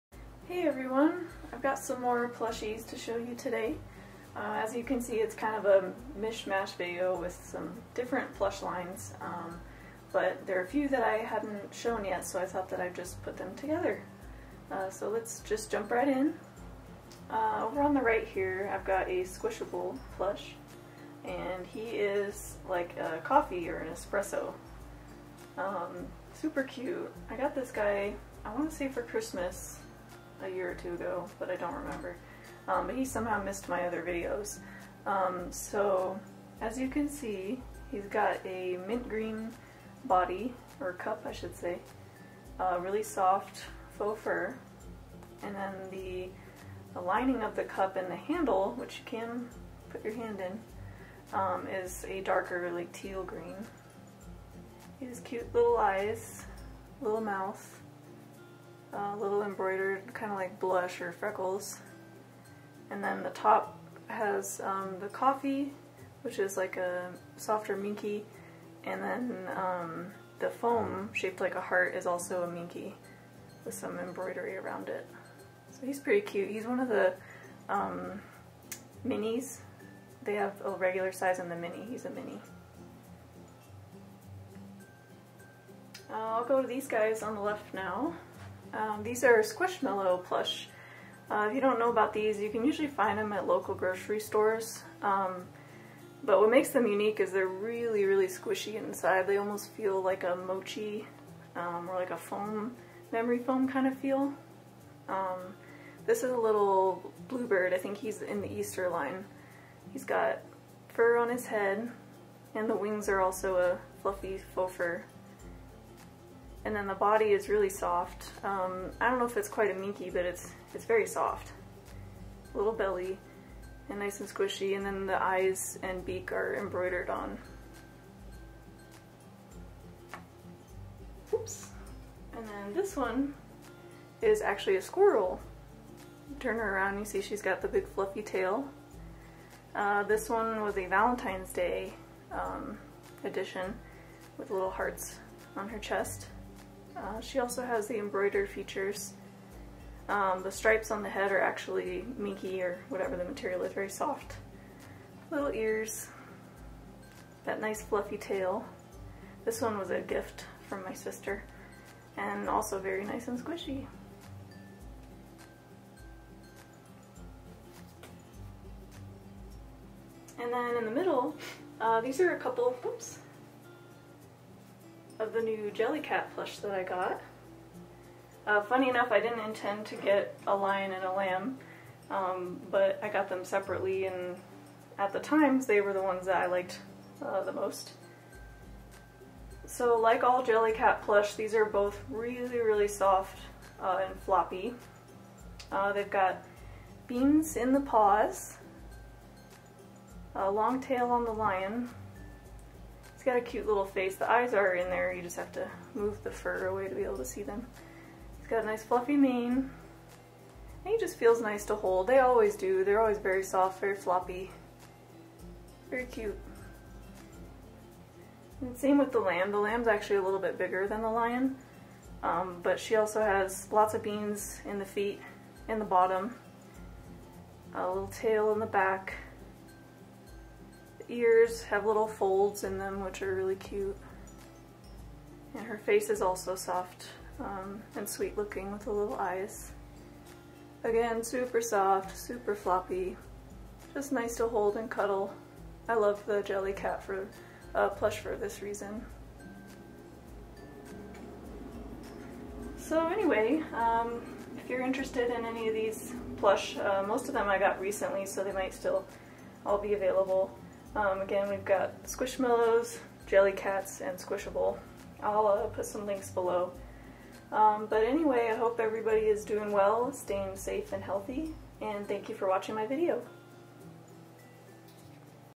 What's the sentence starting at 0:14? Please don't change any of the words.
Uh, so let's just jump right in.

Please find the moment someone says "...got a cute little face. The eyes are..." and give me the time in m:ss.
3:23.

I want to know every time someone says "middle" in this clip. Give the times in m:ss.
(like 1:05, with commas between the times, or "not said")
2:50.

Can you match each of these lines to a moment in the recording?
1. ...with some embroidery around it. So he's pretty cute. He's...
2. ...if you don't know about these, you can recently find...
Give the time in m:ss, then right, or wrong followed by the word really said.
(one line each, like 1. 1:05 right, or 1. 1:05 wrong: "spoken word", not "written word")
1. 1:13 right
2. 1:31 wrong: "usually", not "recently".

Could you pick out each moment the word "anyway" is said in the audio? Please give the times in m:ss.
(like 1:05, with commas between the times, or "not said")
4:13, 4:28.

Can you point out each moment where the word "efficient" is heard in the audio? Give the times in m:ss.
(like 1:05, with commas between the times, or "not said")
not said.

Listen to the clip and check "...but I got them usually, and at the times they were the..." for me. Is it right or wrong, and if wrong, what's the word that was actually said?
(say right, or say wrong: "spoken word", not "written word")
wrong: "separately", not "usually".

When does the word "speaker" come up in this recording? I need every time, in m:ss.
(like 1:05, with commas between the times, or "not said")
not said.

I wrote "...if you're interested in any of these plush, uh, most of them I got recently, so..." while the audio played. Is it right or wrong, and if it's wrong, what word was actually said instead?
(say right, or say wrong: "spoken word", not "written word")
right.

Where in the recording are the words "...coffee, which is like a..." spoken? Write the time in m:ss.
1:05.